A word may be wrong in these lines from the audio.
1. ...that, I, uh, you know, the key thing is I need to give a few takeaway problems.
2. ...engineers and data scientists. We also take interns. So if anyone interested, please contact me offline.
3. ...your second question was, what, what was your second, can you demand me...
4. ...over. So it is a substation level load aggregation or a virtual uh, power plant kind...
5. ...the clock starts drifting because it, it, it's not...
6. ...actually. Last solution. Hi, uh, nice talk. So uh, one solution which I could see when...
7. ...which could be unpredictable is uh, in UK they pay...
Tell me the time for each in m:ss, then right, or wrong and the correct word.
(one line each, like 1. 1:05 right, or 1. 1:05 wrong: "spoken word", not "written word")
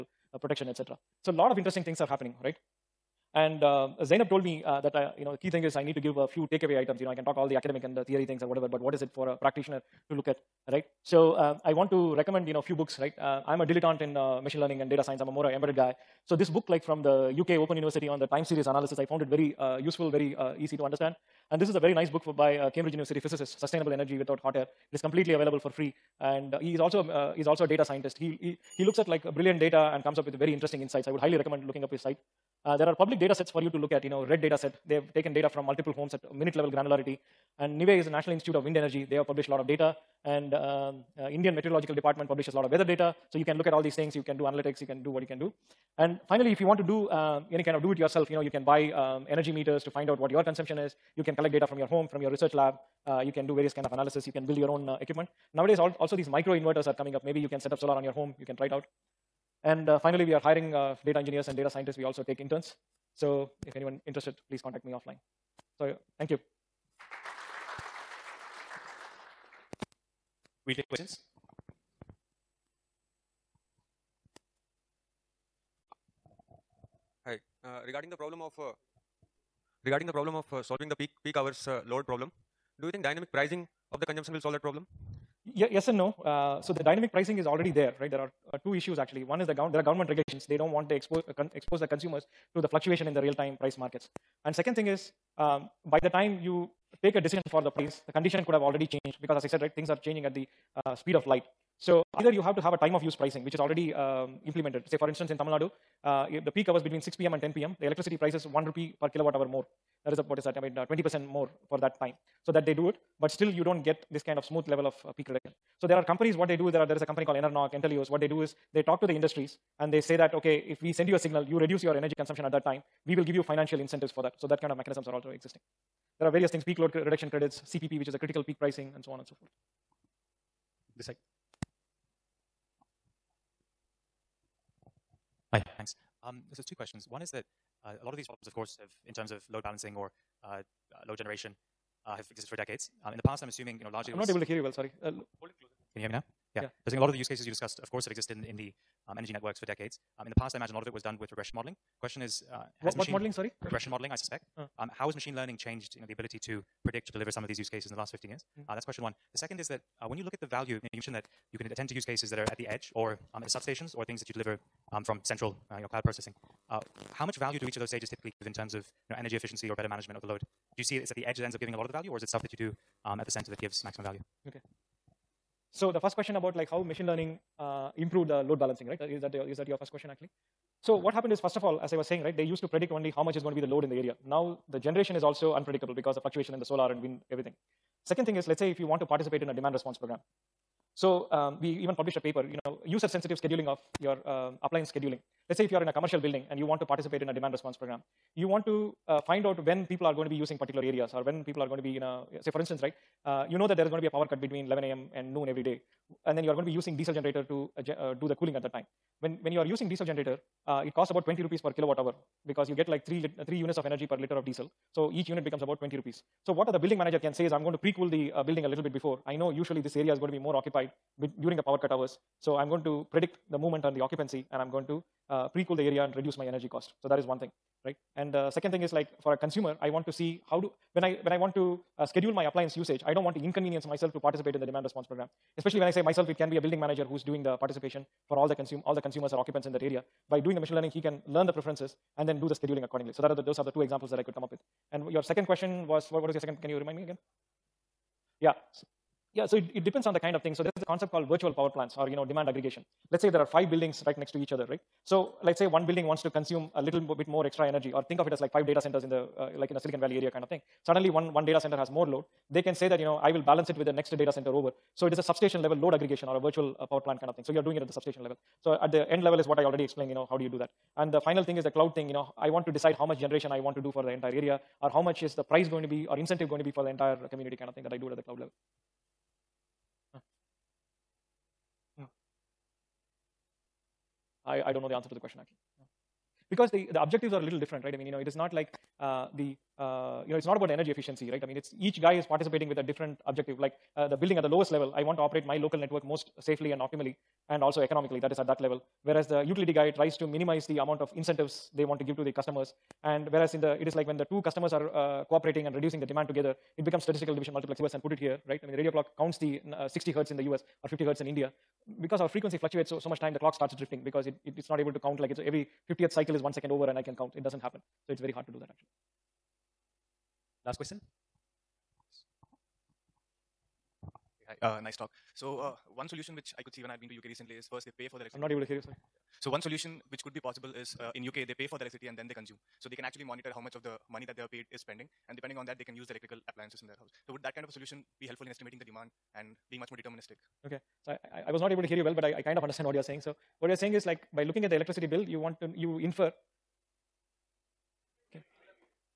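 1. 0:04 wrong: "items", not "problems"
2. 1:01 right
3. 4:05 wrong: "remind", not "demand"
4. 4:24 right
5. 5:13 right
6. 5:18 wrong: "question", not "solution"
7. 5:30 wrong: "possible", not "unpredictable".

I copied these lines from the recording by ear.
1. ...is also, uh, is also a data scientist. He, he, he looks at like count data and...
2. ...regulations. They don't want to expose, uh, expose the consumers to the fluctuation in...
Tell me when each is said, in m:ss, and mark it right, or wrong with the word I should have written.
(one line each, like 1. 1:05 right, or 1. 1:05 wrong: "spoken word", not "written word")
1. 0:26 wrong: "brilliant", not "count"
2. 1:30 right.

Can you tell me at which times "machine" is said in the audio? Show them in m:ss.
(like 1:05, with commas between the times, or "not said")
0:14, 2:35, 2:56, 4:00.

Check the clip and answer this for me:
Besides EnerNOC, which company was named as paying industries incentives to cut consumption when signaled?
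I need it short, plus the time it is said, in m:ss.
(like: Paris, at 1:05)
Entelios, at 1:57.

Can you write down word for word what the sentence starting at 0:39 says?
They have published a lot of data.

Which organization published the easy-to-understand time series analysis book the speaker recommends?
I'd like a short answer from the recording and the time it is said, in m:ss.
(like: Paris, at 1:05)
UK Open University, at 0:17.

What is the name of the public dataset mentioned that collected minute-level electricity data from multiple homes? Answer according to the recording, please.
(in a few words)
REDD.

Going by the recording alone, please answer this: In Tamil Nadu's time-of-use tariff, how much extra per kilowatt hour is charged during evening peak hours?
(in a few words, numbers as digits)
1 rupee.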